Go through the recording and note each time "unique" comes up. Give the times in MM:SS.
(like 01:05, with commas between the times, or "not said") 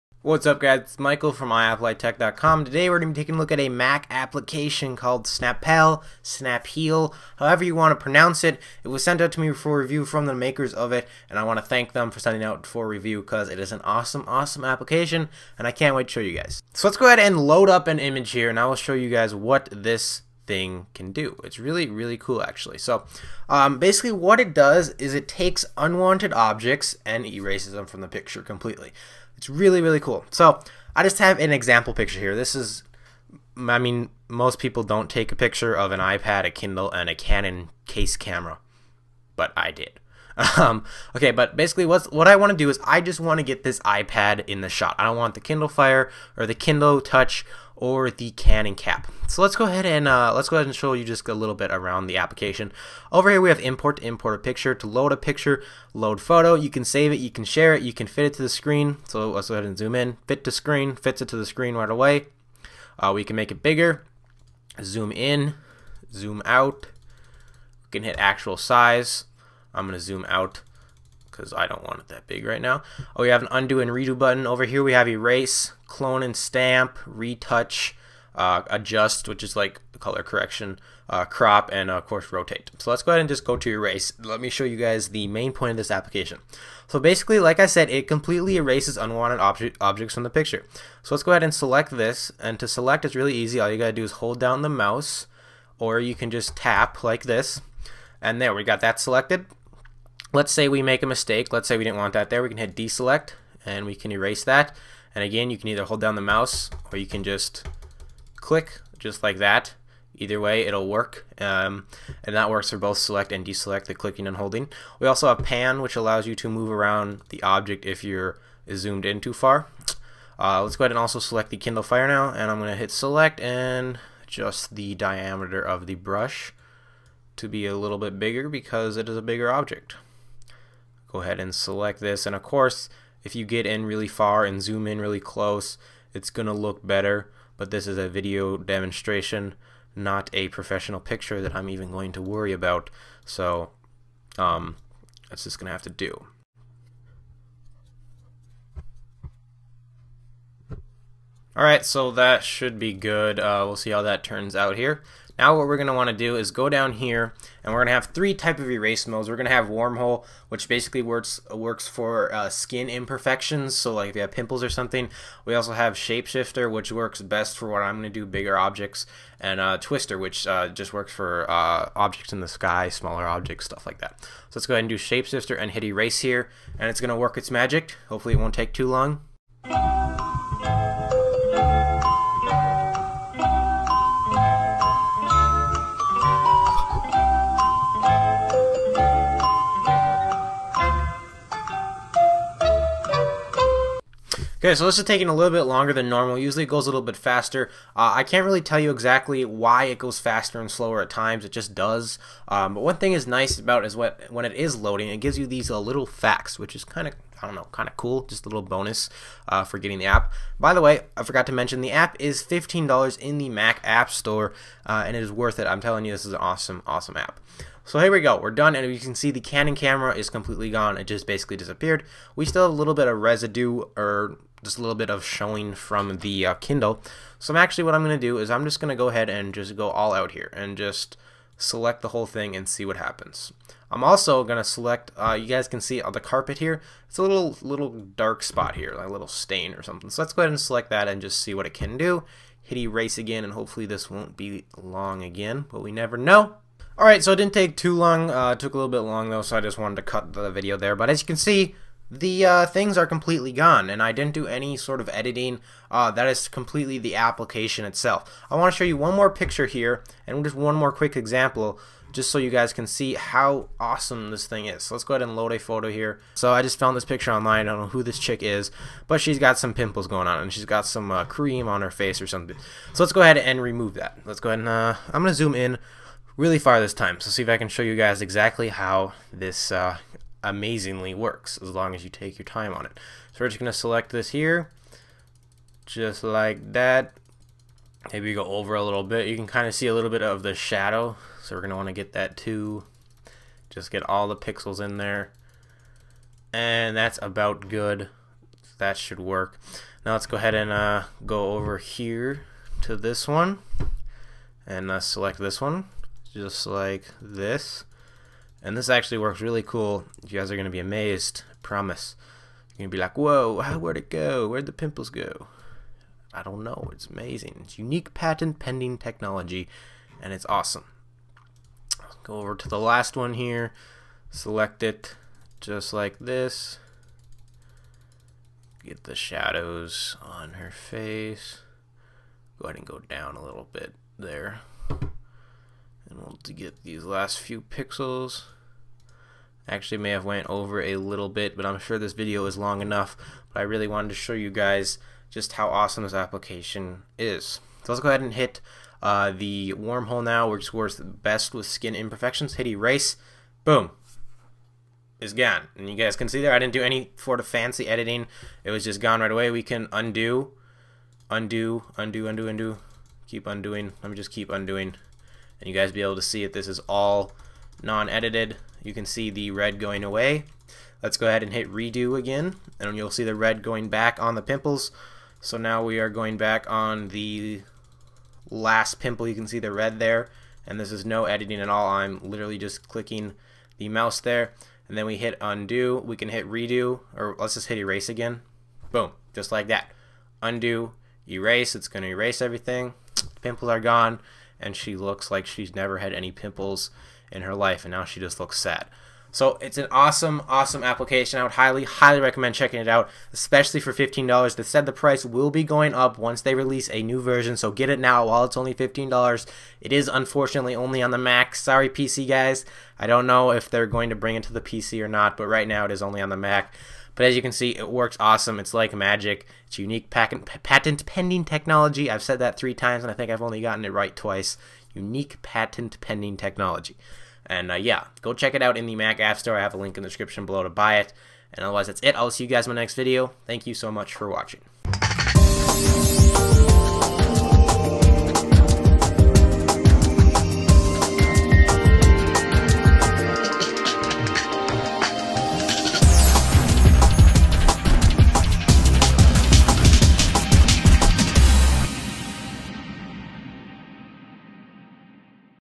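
05:17, 06:59, 07:04.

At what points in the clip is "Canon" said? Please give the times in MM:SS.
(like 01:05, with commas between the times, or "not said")
00:37, 00:48, 03:39.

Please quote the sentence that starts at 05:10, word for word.
You guys are going to be amazed, I promise.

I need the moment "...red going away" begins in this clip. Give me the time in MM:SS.
06:09.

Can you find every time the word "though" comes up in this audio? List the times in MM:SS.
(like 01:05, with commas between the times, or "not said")
04:09.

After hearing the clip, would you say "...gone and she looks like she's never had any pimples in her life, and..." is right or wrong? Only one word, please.
right.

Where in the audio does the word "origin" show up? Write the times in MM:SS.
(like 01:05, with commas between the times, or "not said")
not said.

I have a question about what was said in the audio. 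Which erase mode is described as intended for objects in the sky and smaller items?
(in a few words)
Twister.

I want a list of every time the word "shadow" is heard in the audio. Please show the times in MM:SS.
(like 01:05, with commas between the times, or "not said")
04:50, 05:29.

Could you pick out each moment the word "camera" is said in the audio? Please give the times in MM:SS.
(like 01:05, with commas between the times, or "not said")
00:38, 03:39.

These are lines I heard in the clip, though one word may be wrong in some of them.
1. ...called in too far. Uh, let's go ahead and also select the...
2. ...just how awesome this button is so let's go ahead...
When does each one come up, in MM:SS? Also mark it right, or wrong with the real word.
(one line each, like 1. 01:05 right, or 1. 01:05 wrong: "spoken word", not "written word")
1. 01:58 wrong: "zoomed", not "called"
2. 05:45 wrong: "application", not "button".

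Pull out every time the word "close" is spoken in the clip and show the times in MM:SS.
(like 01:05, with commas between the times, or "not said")
02:15.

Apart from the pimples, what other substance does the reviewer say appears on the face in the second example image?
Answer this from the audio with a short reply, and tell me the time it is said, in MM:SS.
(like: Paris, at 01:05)
Cream, at 04:31.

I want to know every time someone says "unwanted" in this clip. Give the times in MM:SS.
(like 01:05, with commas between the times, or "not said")
00:25, 01:28.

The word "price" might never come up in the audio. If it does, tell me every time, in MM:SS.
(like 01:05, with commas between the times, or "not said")
06:44.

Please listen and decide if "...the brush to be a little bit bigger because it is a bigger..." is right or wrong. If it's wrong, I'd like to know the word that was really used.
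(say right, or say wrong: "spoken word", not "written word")
right.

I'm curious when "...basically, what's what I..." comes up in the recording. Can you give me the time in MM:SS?
00:41.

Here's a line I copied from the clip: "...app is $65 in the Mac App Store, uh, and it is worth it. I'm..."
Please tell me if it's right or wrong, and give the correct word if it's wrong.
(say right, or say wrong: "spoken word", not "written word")
wrong: "15", not "65".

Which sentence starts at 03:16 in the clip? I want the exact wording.
Usually it goes a little bit faster.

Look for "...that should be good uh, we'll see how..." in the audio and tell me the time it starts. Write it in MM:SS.
02:32.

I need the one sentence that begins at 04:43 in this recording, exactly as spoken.
So we're just going to select this here, just like that.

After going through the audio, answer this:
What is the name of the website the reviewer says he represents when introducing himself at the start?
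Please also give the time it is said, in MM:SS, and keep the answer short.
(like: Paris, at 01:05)
iAppleiTech.com, at 00:01.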